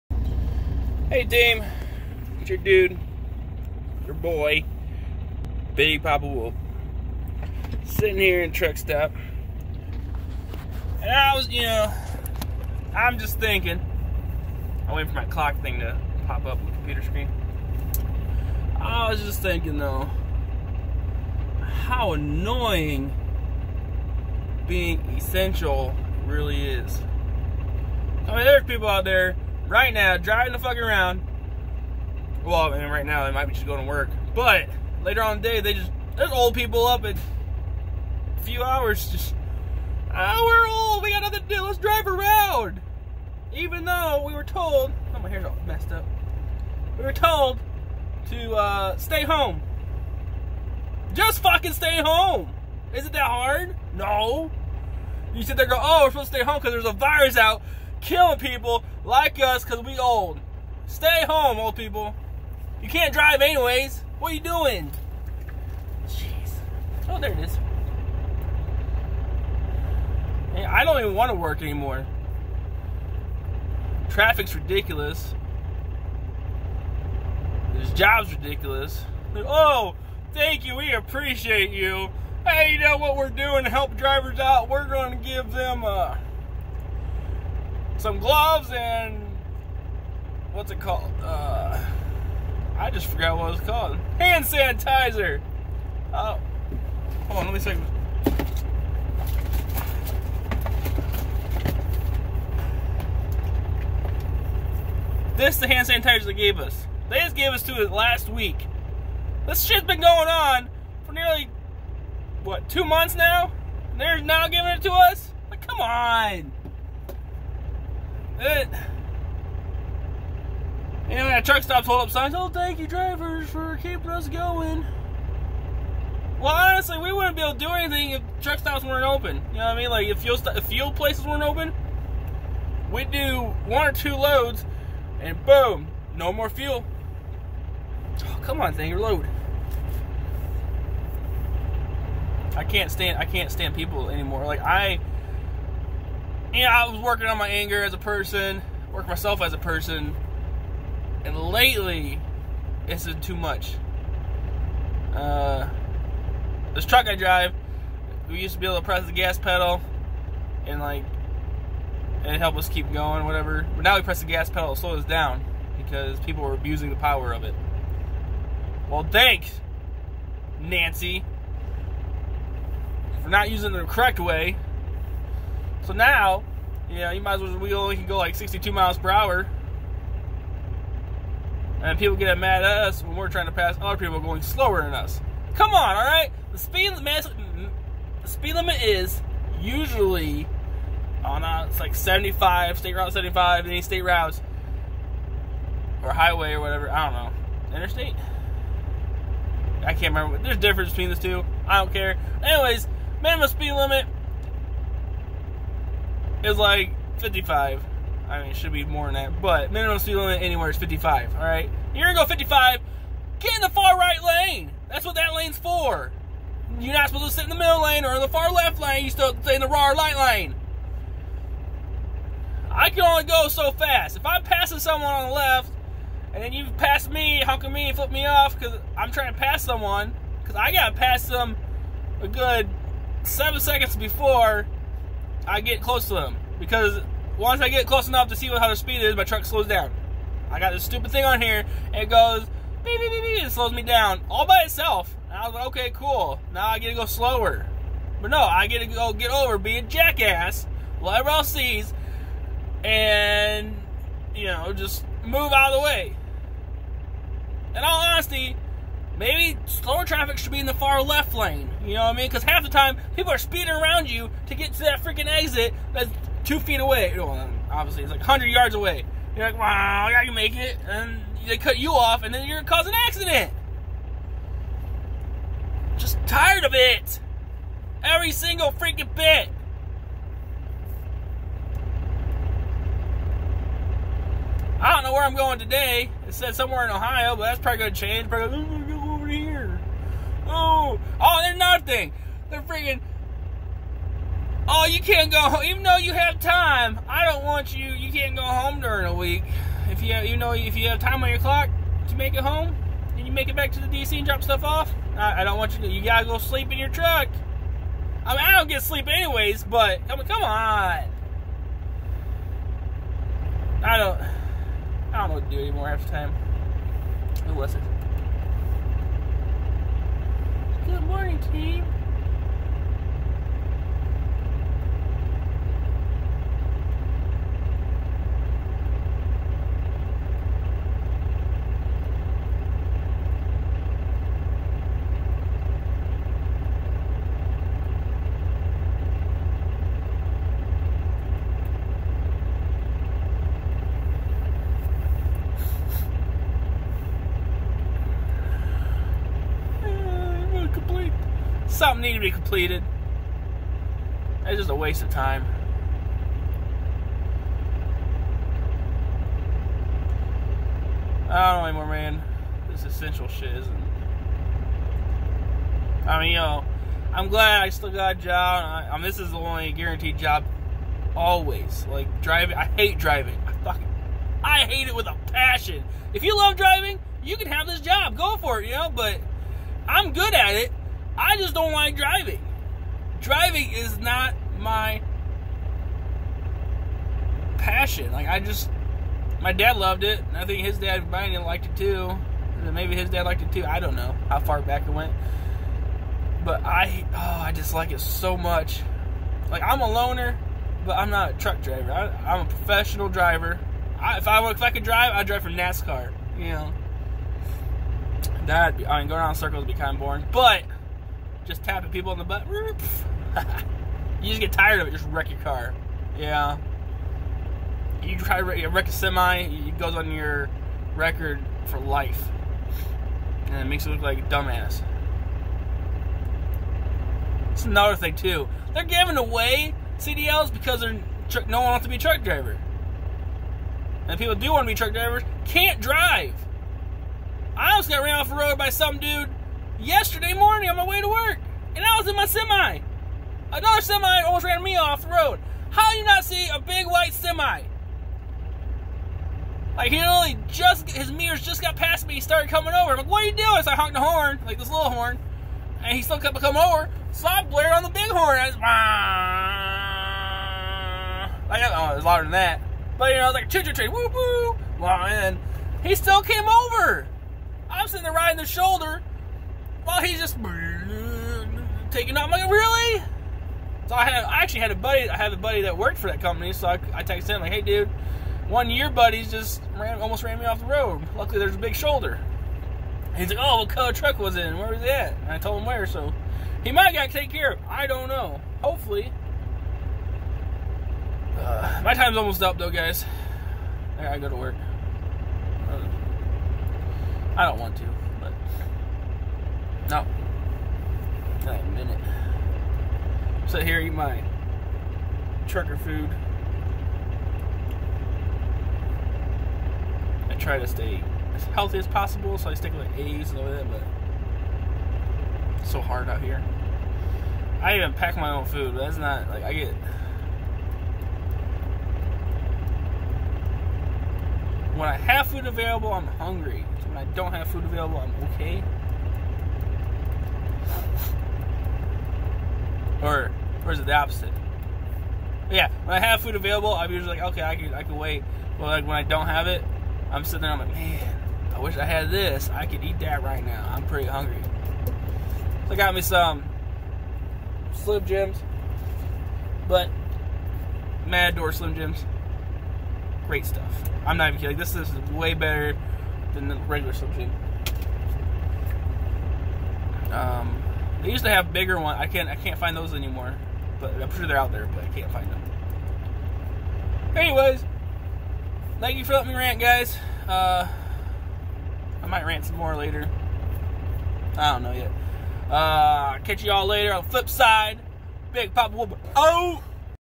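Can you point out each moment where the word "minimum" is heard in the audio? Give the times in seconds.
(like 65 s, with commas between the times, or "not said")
203 s, 209 s.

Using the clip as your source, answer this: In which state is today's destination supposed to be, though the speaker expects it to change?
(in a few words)
Ohio.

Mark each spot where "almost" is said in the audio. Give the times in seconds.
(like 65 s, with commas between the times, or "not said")
437 s, 444 s, 480 s, 492 s.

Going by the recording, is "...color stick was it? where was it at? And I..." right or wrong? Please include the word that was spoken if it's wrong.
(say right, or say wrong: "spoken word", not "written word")
wrong: "truck", not "stick".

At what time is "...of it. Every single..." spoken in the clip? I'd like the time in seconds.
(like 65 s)
276 s.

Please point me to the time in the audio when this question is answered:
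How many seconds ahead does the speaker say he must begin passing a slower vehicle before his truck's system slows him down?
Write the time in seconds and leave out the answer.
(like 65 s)
233 s.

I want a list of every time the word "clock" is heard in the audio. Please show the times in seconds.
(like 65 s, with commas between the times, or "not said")
15 s, 301 s.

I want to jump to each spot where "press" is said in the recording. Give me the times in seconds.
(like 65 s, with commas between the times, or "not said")
158 s, 164 s.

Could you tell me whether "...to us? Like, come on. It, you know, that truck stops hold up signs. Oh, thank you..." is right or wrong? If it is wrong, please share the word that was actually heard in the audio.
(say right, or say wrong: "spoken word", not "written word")
right.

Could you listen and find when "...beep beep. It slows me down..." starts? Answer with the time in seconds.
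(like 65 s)
243 s.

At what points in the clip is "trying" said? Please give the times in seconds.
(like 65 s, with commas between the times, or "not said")
183 s, 229 s.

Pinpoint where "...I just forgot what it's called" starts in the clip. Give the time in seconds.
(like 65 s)
92 s.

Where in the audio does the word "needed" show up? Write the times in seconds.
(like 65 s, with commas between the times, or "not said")
352 s.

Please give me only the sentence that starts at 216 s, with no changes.
You're not supposed to sit in the middle lane or in the far left lane.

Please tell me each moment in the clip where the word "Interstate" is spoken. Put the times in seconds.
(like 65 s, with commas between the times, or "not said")
197 s.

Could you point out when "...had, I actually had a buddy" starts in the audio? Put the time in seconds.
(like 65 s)
474 s.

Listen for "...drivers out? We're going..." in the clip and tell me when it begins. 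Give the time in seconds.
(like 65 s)
83 s.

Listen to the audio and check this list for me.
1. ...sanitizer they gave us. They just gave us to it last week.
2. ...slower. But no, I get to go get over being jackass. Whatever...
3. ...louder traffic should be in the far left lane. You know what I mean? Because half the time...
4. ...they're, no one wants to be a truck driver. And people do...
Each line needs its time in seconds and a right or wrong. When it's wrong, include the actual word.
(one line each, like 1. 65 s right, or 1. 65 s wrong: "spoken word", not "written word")
1. 105 s right
2. 247 s right
3. 259 s wrong: "slower", not "louder"
4. 430 s right.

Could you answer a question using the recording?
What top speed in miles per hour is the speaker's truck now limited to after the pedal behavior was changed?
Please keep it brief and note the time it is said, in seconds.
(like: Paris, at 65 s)
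62, at 178 s.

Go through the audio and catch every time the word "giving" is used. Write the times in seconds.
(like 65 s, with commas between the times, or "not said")
114 s, 428 s.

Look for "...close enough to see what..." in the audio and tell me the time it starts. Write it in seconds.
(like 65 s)
237 s.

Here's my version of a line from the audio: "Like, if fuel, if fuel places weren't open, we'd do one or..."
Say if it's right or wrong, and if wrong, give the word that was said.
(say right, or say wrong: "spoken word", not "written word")
right.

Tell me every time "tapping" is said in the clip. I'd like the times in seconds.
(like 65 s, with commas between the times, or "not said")
411 s.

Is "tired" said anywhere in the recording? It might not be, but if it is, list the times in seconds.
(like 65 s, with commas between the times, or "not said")
276 s, 414 s.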